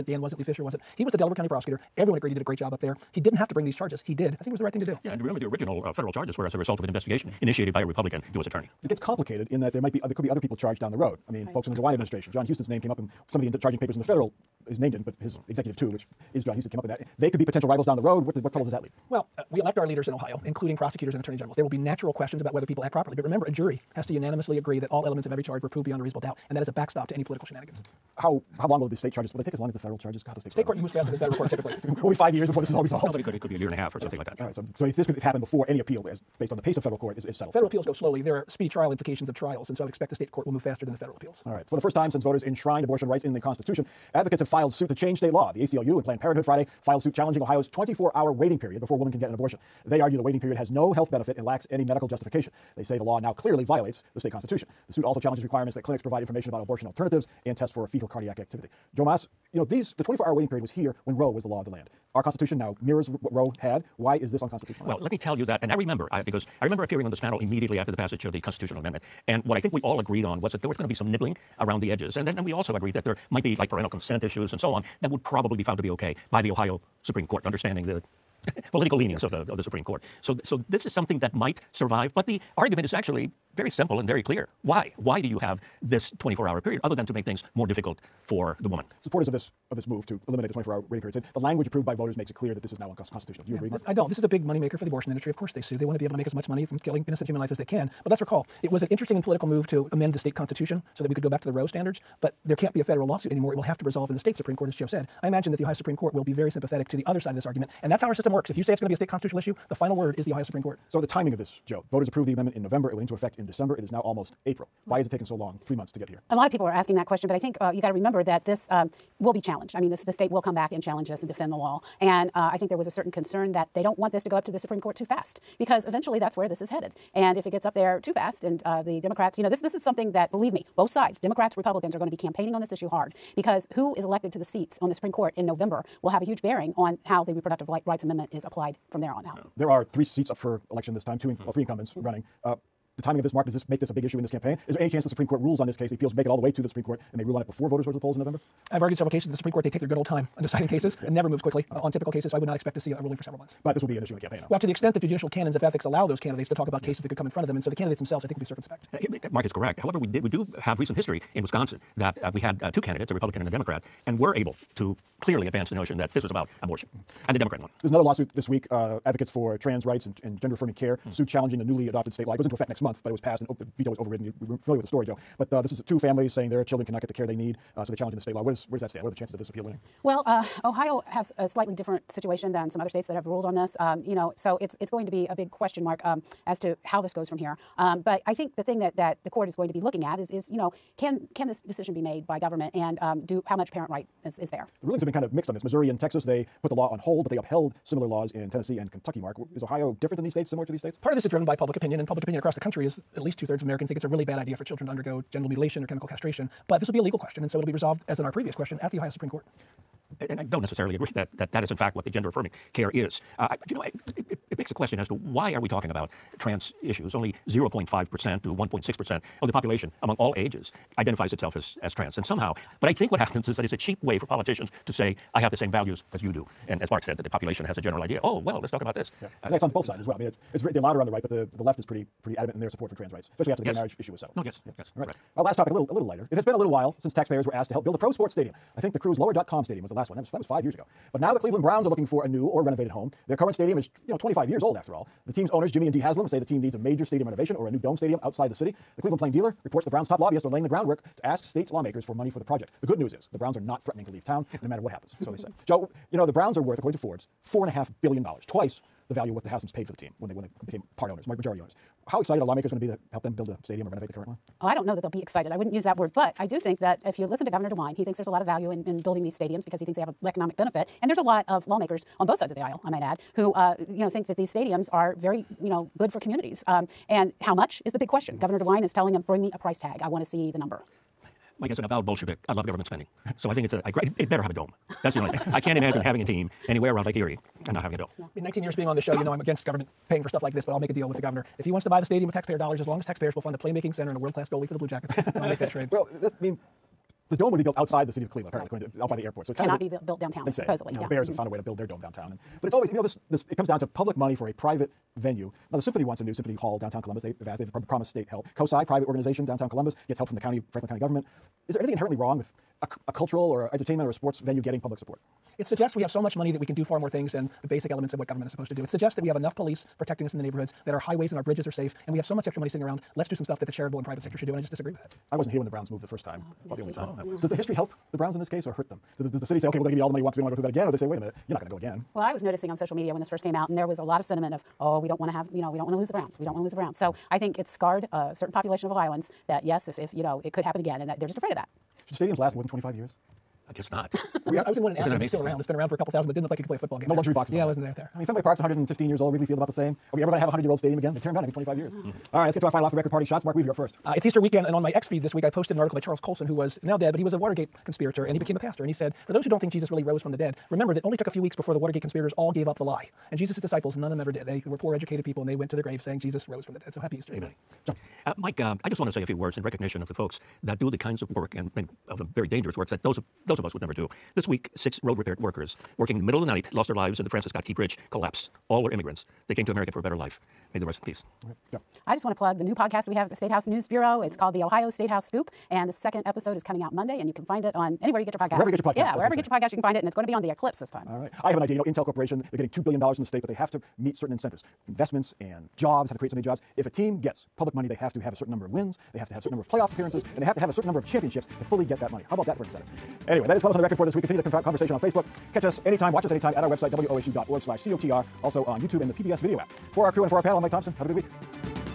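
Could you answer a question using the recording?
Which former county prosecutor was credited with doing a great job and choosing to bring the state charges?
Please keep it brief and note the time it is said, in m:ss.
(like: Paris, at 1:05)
Lee Fisher, at 0:00.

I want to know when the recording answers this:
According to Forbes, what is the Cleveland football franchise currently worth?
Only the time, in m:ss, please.
4:17.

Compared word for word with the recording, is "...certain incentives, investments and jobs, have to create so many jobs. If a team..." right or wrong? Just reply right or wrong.
right.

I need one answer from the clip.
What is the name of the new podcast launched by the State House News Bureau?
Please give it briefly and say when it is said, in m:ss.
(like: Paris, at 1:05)
The Ohio State House Scoop, at 6:24.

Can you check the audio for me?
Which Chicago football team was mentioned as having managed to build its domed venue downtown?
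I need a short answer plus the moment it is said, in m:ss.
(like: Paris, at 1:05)
The Bears, at 5:01.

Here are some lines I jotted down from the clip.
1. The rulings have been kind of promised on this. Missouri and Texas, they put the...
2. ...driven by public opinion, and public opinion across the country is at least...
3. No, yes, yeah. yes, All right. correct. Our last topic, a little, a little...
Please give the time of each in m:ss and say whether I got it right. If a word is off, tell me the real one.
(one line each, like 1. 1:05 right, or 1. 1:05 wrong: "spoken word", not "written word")
1. 3:14 wrong: "mixed", not "promised"
2. 3:21 right
3. 3:54 right.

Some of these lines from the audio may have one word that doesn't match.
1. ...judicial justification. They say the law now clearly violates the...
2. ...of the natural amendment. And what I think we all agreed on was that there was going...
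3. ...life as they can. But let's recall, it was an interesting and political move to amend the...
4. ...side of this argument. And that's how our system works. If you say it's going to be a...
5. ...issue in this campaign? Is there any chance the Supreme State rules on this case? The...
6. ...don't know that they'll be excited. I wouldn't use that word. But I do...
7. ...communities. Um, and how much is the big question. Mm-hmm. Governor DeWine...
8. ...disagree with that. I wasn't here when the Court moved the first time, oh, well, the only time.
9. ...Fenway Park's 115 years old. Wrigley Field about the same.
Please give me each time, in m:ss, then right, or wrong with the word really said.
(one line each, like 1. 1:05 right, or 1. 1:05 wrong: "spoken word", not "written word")
1. 0:51 wrong: "medical", not "judicial"
2. 1:08 wrong: "constitutional", not "natural"
3. 1:37 right
4. 1:47 right
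5. 2:24 wrong: "Court", not "State"
6. 4:24 right
7. 4:36 right
8. 5:24 wrong: "Browns", not "Court"
9. 5:48 right.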